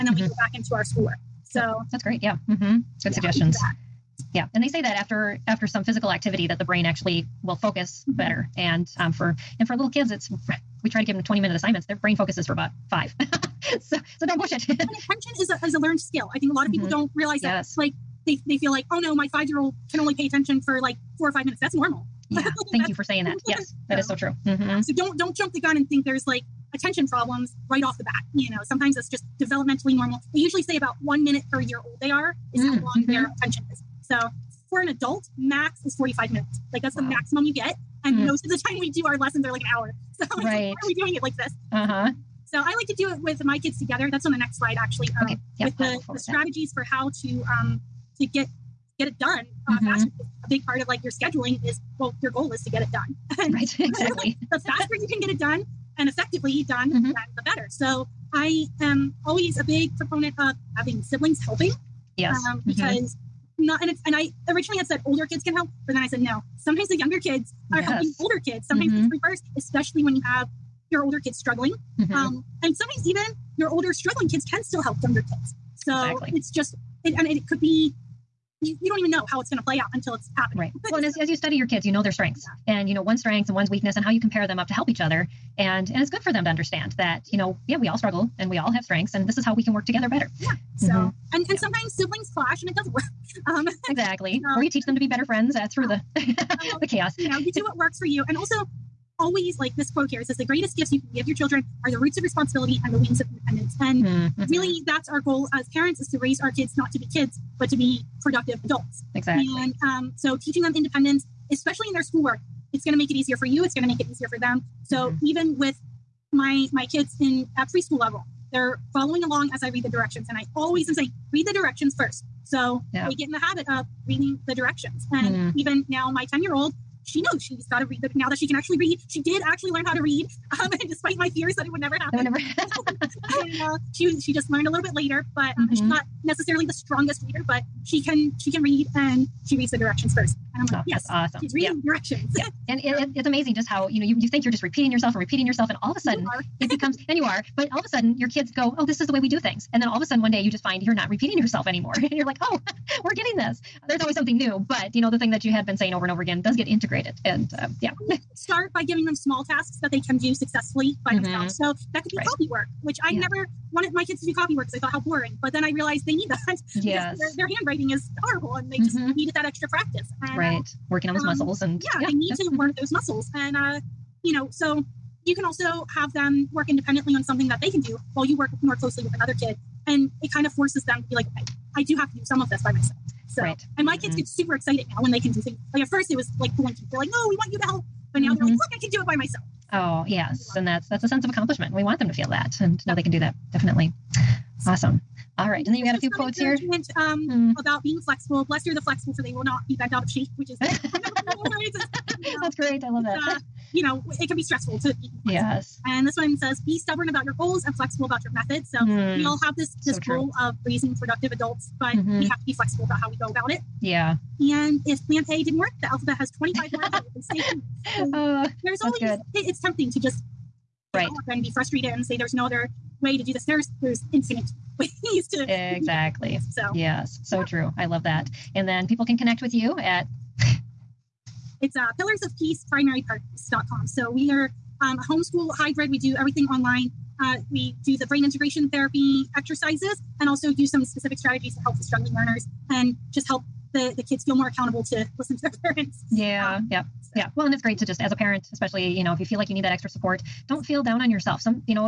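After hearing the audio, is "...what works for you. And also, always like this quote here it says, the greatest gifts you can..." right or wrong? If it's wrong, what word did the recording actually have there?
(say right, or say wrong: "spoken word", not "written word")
right.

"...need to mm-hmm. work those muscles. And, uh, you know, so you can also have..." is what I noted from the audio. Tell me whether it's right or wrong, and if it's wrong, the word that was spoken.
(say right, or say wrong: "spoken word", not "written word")
right.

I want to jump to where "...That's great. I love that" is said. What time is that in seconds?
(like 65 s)
200 s.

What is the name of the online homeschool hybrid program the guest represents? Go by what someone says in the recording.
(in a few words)
Pillars of Peace Primary.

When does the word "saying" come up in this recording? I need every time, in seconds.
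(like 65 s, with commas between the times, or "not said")
23 s, 120 s, 155 s.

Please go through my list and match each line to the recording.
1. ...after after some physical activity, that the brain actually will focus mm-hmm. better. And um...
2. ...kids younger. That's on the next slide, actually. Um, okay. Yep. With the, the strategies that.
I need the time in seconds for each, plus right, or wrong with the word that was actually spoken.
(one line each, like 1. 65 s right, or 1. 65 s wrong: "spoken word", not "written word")
1. 4 s right
2. 43 s wrong: "together", not "younger".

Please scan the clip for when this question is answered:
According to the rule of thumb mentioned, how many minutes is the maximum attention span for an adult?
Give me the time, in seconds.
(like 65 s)
35 s.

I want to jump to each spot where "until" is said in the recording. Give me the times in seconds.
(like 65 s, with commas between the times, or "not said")
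79 s.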